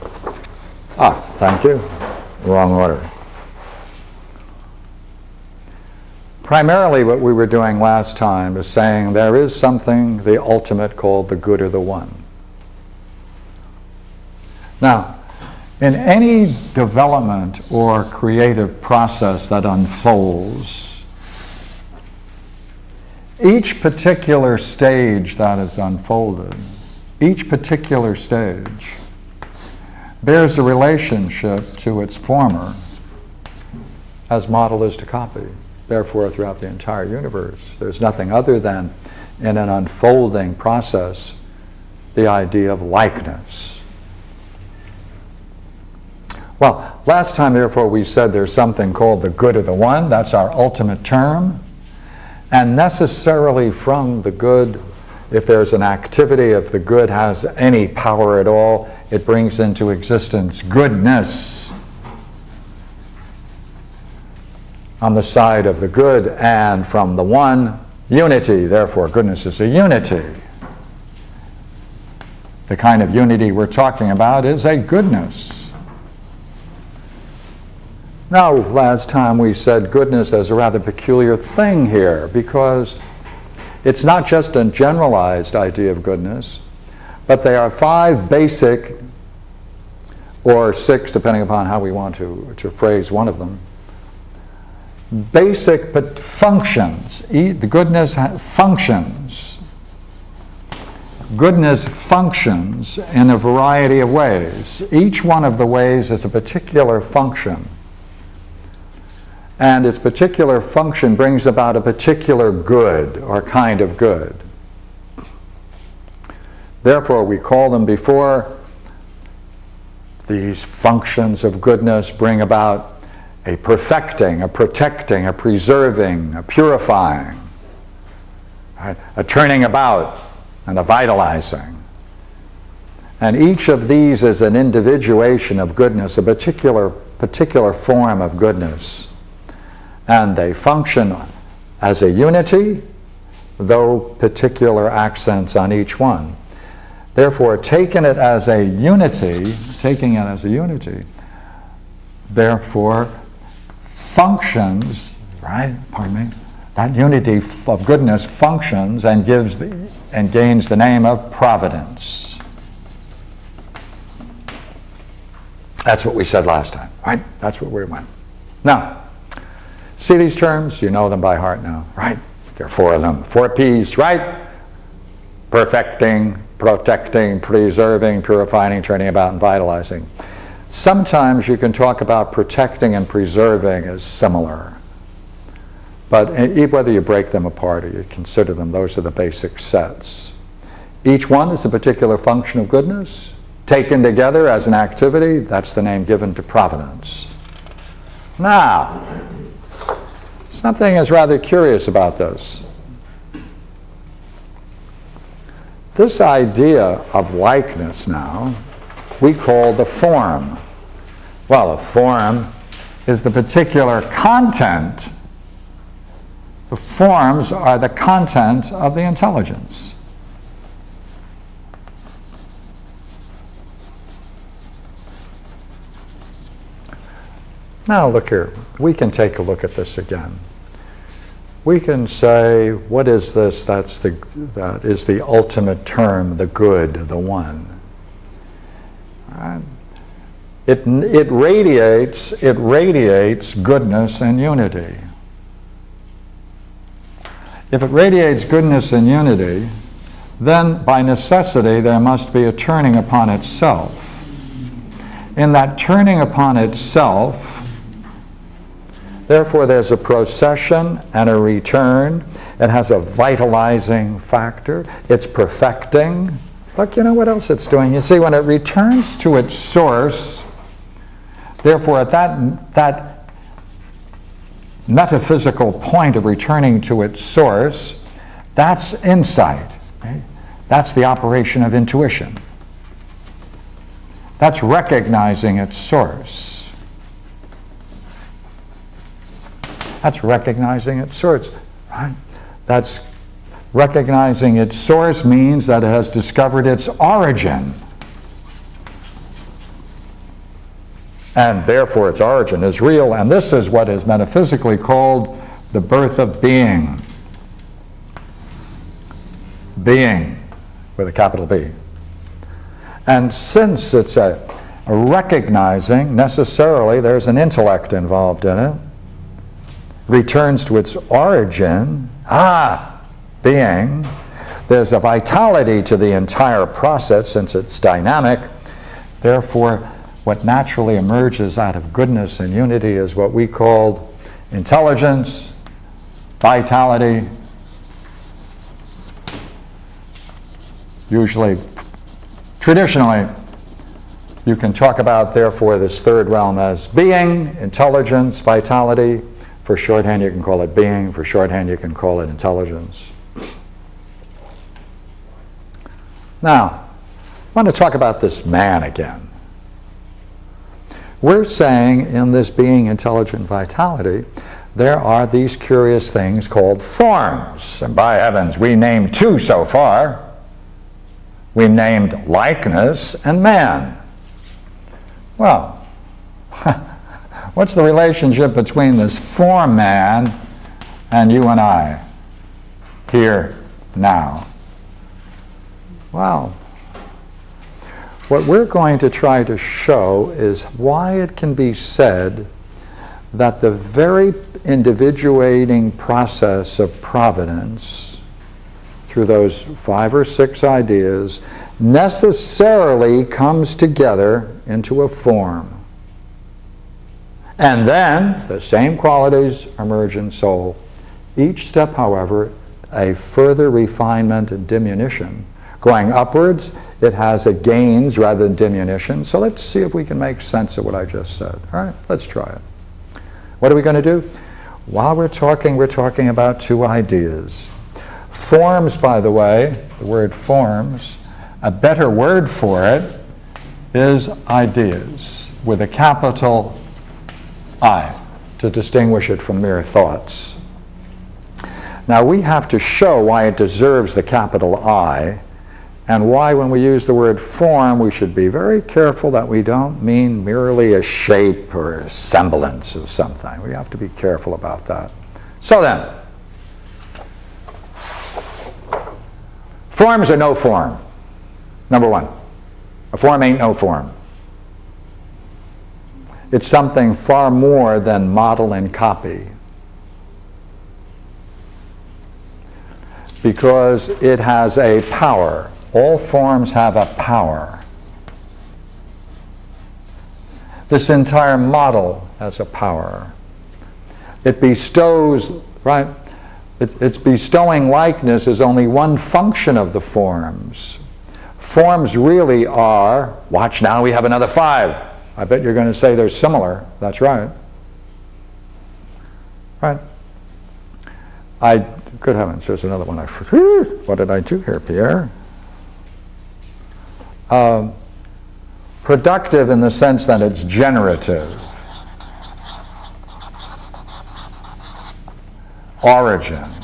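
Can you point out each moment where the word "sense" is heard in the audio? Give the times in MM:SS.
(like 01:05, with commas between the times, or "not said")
07:00, 08:29.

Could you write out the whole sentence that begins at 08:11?
Forms really are, watch now, we have another five.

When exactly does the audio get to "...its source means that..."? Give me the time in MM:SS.
04:54.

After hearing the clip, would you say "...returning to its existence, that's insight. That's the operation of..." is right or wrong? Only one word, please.
wrong.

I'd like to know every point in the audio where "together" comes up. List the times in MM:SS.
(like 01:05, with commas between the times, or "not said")
03:14, 06:43.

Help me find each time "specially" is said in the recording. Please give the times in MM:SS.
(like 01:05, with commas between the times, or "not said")
not said.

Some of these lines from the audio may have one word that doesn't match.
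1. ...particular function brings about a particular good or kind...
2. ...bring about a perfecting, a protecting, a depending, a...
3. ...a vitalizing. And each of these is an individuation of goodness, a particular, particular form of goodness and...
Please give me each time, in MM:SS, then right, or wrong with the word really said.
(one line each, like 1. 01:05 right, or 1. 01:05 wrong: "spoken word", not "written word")
1. 01:49 right
2. 02:02 wrong: "preserving", not "depending"
3. 02:10 right.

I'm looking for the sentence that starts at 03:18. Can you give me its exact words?
Now, Something is rather curious about this.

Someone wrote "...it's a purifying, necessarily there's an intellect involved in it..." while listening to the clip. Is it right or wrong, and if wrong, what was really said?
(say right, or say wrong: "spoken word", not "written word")
wrong: "recognizing", not "purifying".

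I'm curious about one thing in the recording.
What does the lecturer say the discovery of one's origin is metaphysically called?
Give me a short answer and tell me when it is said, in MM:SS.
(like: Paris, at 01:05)
the birth of being, at 05:05.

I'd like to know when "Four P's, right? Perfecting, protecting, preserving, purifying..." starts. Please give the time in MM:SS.
02:53.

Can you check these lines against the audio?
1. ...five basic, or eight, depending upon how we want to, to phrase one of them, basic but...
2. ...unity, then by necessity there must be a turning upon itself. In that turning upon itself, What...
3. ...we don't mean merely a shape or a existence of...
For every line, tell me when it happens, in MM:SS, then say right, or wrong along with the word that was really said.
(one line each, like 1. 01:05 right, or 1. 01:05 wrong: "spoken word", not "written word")
1. 01:27 wrong: "six", not "eight"
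2. 04:09 wrong: "Therefore", not "What"
3. 07:29 wrong: "semblance", not "existence".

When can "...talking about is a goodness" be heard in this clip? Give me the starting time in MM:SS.
01:13.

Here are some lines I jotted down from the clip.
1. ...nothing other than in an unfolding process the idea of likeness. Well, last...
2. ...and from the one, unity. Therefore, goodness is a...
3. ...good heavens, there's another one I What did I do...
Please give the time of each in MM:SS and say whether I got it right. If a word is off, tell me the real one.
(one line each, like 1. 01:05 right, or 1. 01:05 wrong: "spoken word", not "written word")
1. 00:38 right
2. 01:06 right
3. 08:22 right.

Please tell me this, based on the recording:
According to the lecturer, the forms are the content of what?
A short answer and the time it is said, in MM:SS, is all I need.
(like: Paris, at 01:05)
the intelligence, at 03:38.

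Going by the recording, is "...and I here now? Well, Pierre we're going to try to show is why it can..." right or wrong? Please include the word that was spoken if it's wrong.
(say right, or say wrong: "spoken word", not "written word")
wrong: "What", not "Pierre".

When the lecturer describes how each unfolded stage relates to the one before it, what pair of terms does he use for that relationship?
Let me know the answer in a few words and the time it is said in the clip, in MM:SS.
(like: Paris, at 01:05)
model and copy, at 00:34.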